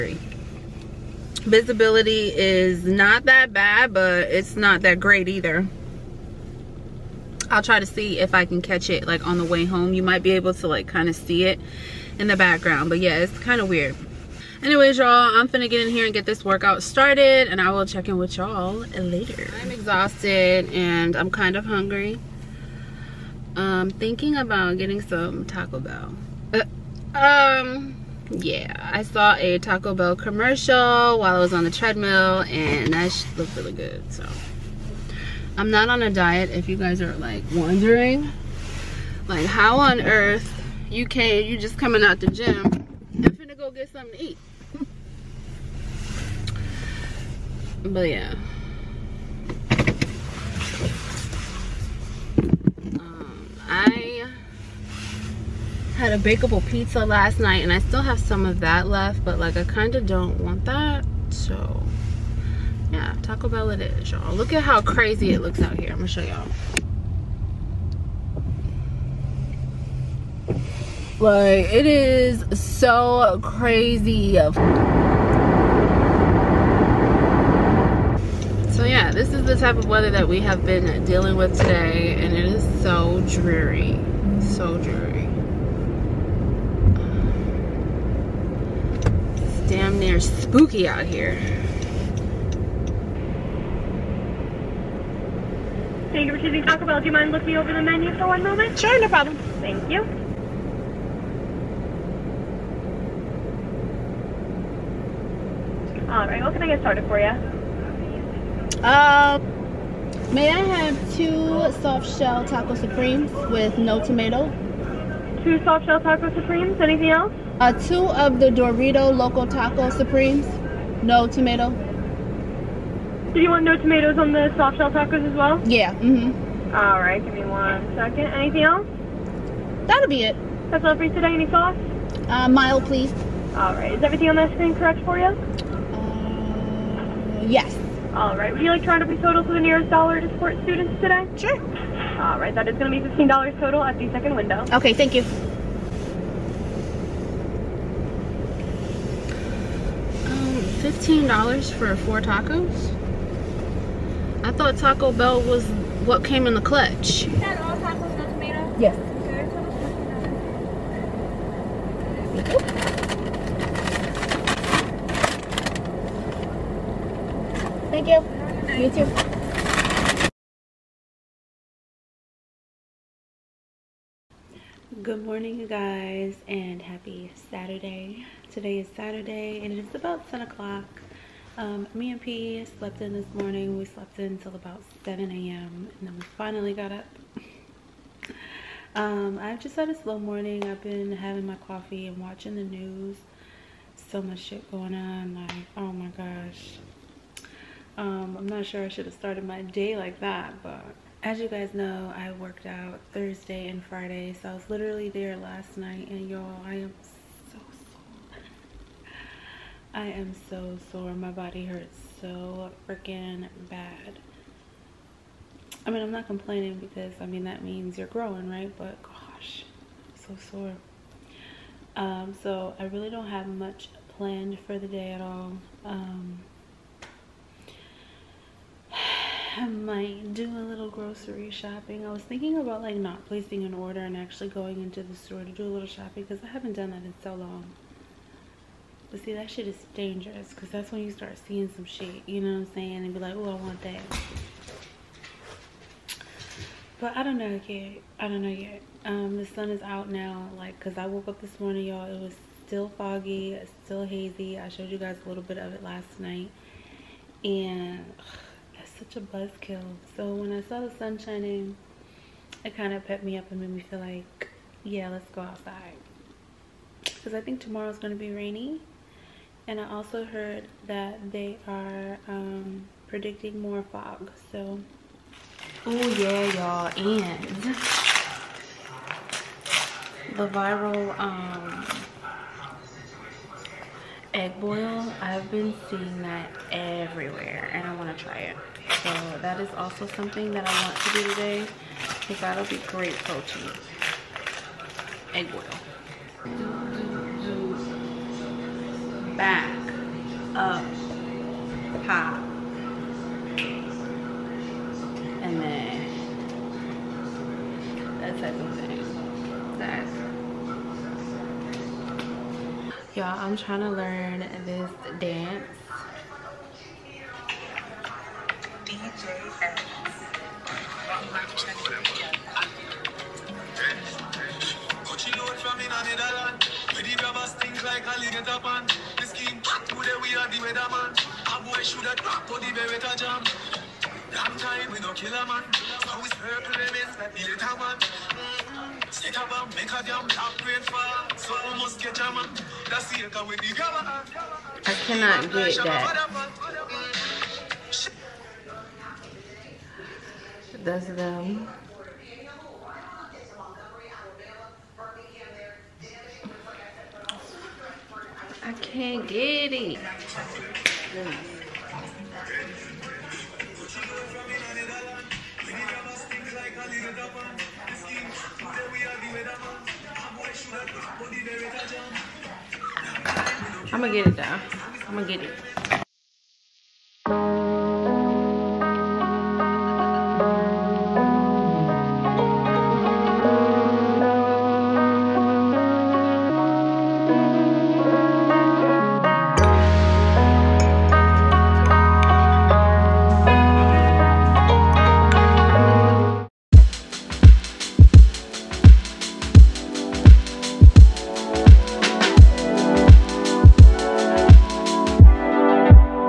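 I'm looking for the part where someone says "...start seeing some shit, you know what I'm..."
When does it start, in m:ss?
4:01.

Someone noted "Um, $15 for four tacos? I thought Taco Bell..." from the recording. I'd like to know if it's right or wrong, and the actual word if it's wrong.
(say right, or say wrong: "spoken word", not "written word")
right.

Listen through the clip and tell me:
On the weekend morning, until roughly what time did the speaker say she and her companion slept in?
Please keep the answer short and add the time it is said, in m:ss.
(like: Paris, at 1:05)
7 a.m., at 3:05.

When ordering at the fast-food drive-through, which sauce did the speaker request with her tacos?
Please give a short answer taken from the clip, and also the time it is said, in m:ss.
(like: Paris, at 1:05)
mild, at 2:12.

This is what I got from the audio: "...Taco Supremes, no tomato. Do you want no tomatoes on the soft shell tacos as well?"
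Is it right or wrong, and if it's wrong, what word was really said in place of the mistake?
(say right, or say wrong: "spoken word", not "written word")
right.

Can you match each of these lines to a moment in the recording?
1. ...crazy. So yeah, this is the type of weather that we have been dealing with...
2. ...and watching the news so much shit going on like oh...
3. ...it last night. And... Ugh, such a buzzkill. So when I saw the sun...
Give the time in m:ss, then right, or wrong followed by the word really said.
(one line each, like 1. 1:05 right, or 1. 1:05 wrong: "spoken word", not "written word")
1. 1:13 right
2. 3:12 right
3. 4:15 right.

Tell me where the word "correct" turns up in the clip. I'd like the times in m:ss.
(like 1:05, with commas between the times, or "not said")
2:14.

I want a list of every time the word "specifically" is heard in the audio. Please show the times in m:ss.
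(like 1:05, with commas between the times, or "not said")
not said.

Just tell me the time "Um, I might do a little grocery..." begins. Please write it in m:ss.
3:45.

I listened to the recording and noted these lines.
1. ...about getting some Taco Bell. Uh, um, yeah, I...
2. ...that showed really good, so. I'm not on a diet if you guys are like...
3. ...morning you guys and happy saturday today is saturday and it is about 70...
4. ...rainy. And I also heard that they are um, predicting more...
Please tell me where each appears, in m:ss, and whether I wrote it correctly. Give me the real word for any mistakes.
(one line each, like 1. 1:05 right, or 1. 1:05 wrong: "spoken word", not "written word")
1. 0:24 right
2. 0:32 wrong: "looked", not "showed"
3. 2:55 wrong: "10", not "70"
4. 4:28 right.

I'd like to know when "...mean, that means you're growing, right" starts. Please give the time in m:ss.
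3:37.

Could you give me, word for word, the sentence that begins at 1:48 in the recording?
Uh, may I have two soft shell taco supremes with no tomato?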